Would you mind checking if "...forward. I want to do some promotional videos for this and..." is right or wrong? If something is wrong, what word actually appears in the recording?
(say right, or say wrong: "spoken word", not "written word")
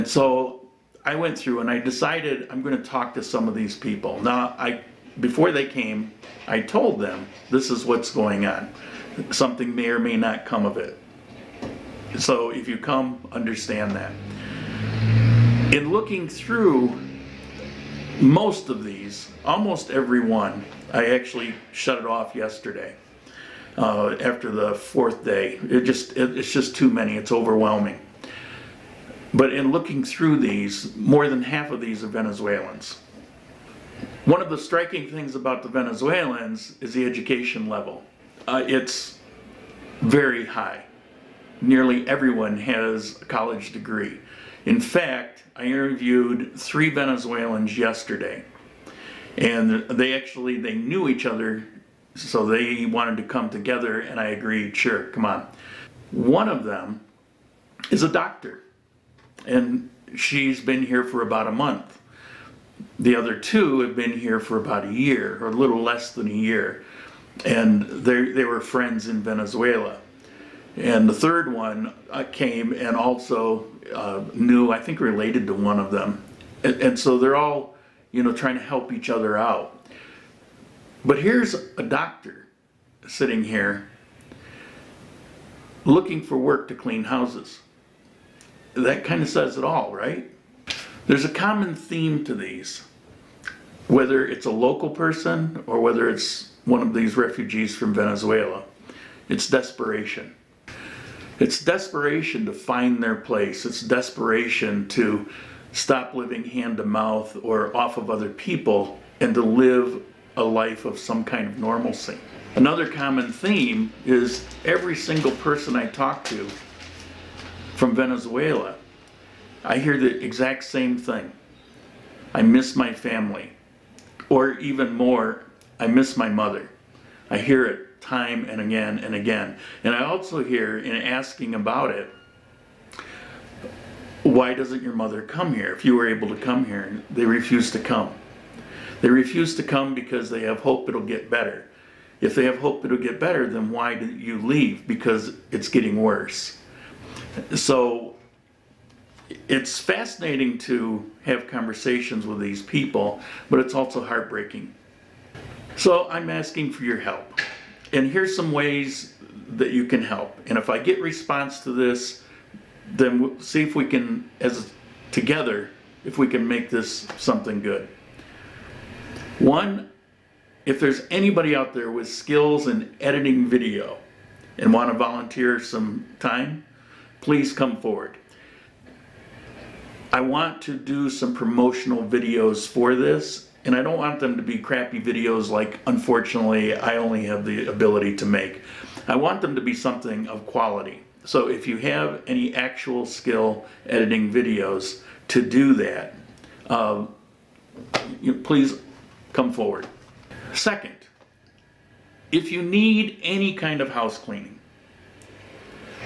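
right.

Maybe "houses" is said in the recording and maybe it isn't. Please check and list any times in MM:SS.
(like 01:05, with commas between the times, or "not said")
01:27, 03:23.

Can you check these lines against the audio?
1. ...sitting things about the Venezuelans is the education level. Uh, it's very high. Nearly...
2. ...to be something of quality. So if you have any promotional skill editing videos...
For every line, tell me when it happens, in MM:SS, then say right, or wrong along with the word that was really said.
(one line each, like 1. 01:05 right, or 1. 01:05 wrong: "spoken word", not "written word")
1. 00:34 wrong: "striking", not "sitting"
2. 03:09 wrong: "actual", not "promotional".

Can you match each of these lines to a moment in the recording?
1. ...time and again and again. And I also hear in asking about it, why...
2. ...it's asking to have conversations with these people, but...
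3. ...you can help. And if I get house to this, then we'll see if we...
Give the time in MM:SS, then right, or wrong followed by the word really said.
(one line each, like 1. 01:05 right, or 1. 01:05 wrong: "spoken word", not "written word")
1. 02:07 right
2. 02:29 wrong: "fascinating", not "asking"
3. 02:39 wrong: "response", not "house".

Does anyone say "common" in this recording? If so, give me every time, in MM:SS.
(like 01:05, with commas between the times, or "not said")
01:31, 01:52.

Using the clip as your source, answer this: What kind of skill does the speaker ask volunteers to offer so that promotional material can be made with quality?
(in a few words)
editing video.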